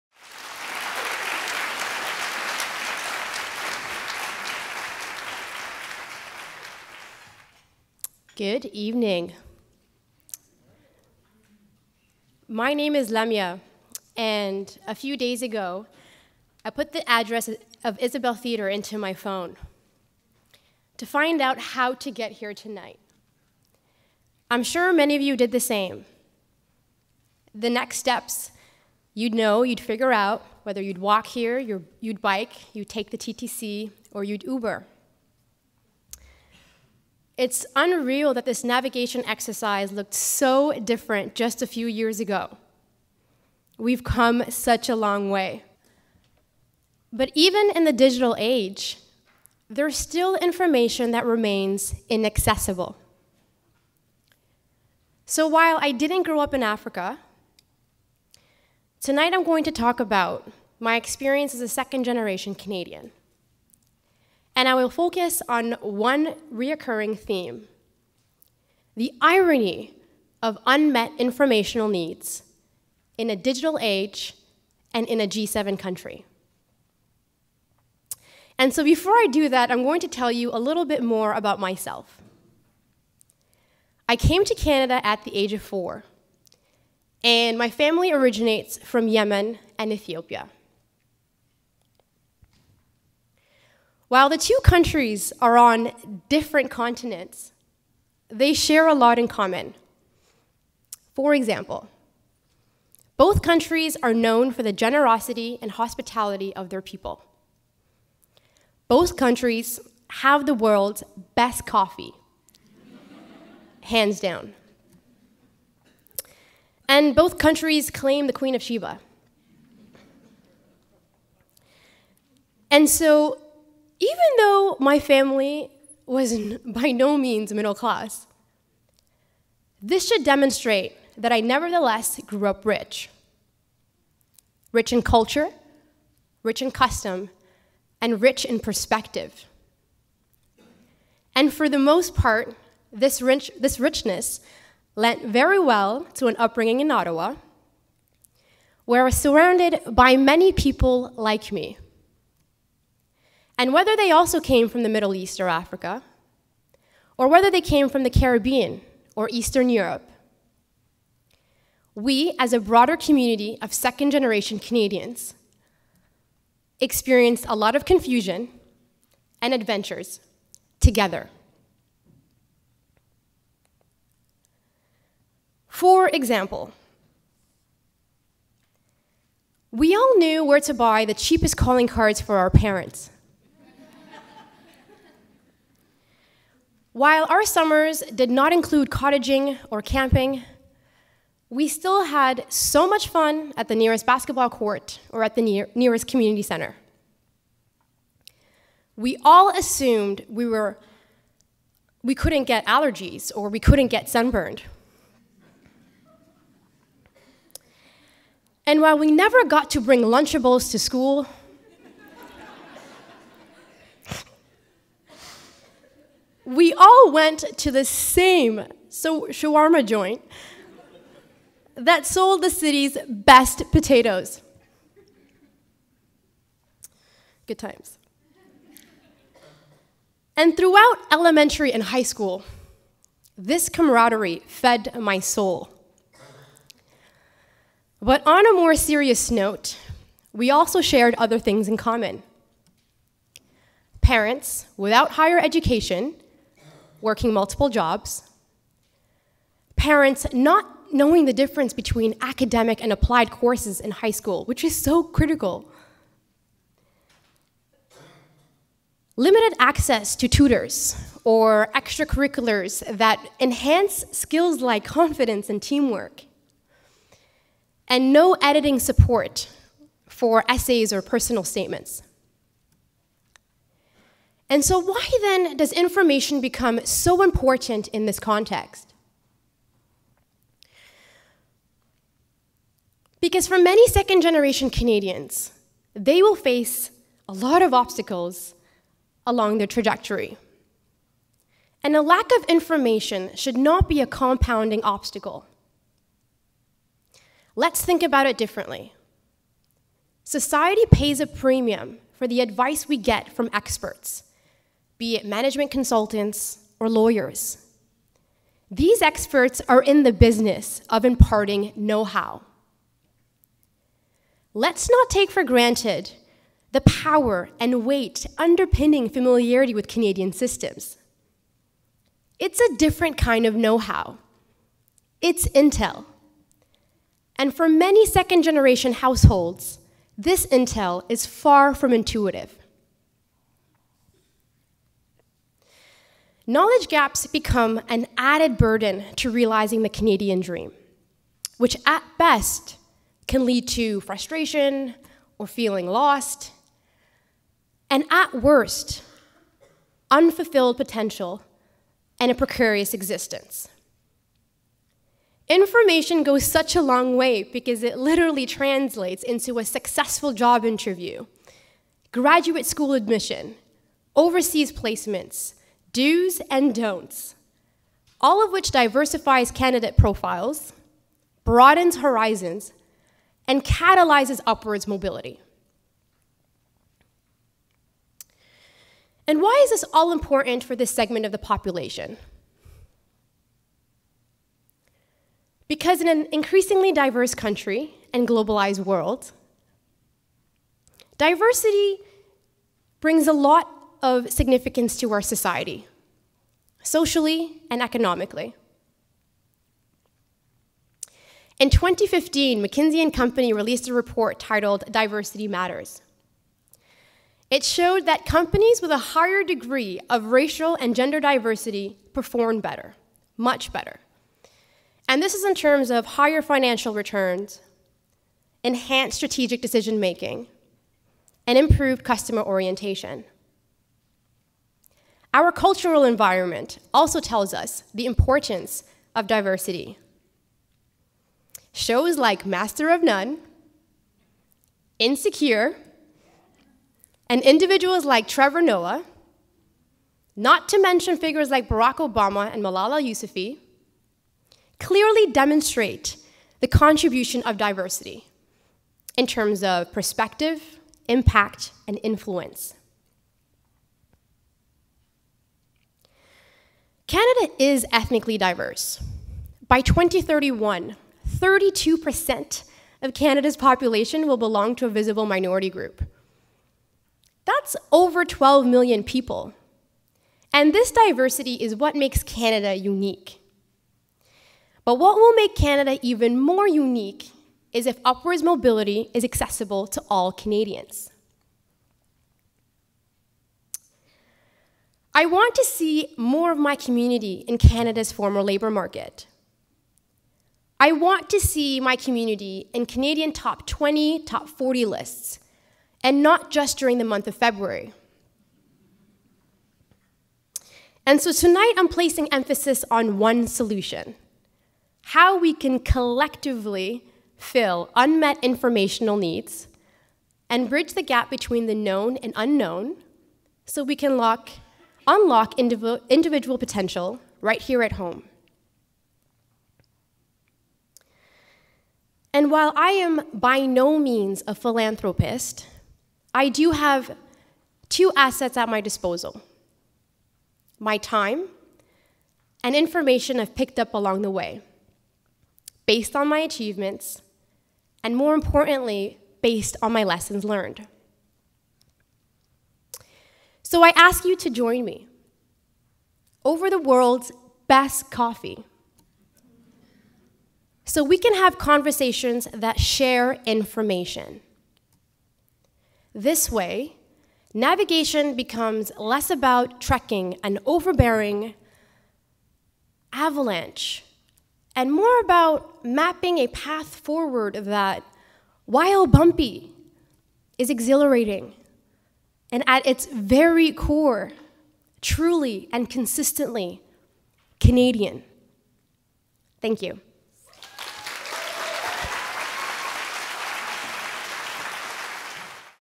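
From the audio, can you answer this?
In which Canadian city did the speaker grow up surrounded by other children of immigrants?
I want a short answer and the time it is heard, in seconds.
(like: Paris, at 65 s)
Ottawa, at 146 s.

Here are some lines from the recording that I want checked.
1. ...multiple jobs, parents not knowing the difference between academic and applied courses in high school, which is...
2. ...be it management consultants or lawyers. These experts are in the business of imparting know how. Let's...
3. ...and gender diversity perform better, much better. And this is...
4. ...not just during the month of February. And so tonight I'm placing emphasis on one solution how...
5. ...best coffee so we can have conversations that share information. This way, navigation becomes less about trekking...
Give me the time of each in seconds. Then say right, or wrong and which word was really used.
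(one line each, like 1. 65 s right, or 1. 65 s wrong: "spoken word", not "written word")
1. 247 s right
2. 305 s right
3. 410 s right
4. 496 s right
5. 547 s right.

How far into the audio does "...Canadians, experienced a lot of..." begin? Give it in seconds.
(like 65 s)
164 s.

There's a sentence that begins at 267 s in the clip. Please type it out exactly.
And no editing support for essays or personal statements.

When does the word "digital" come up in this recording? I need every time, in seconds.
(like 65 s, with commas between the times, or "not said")
47 s, 73 s.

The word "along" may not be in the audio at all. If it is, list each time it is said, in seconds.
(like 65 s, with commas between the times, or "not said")
289 s, 533 s.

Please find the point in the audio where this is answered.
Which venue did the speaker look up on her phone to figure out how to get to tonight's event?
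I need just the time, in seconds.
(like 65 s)
17 s.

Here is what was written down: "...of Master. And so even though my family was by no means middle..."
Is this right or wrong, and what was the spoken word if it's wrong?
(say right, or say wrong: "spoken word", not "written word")
wrong: "Sheba", not "Master".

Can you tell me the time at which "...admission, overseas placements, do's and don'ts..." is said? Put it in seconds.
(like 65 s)
362 s.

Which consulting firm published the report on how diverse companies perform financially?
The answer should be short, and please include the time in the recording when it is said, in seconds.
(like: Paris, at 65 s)
McKinsey and Company, at 402 s.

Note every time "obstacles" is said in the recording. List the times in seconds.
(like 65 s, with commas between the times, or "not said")
287 s, 294 s.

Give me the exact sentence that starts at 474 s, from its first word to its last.
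But what will make Canada even more unique is if upwards mobility is accessible to all Canadians.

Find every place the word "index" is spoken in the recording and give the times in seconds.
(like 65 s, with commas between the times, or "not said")
not said.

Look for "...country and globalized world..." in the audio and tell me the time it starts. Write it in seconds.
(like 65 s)
387 s.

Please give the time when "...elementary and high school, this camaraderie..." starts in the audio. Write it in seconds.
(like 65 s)
231 s.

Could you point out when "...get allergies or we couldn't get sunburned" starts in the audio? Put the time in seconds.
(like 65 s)
202 s.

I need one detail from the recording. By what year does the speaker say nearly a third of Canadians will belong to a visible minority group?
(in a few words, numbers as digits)
2031.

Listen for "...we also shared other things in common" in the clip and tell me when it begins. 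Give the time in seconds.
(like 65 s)
240 s.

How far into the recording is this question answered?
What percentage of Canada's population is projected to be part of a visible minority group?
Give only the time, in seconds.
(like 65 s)
461 s.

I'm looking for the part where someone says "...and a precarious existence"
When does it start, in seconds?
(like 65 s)
352 s.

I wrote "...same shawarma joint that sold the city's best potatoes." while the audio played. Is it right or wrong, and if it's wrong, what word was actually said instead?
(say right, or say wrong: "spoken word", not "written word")
right.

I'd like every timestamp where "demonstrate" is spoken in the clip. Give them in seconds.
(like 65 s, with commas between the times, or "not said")
130 s, 445 s.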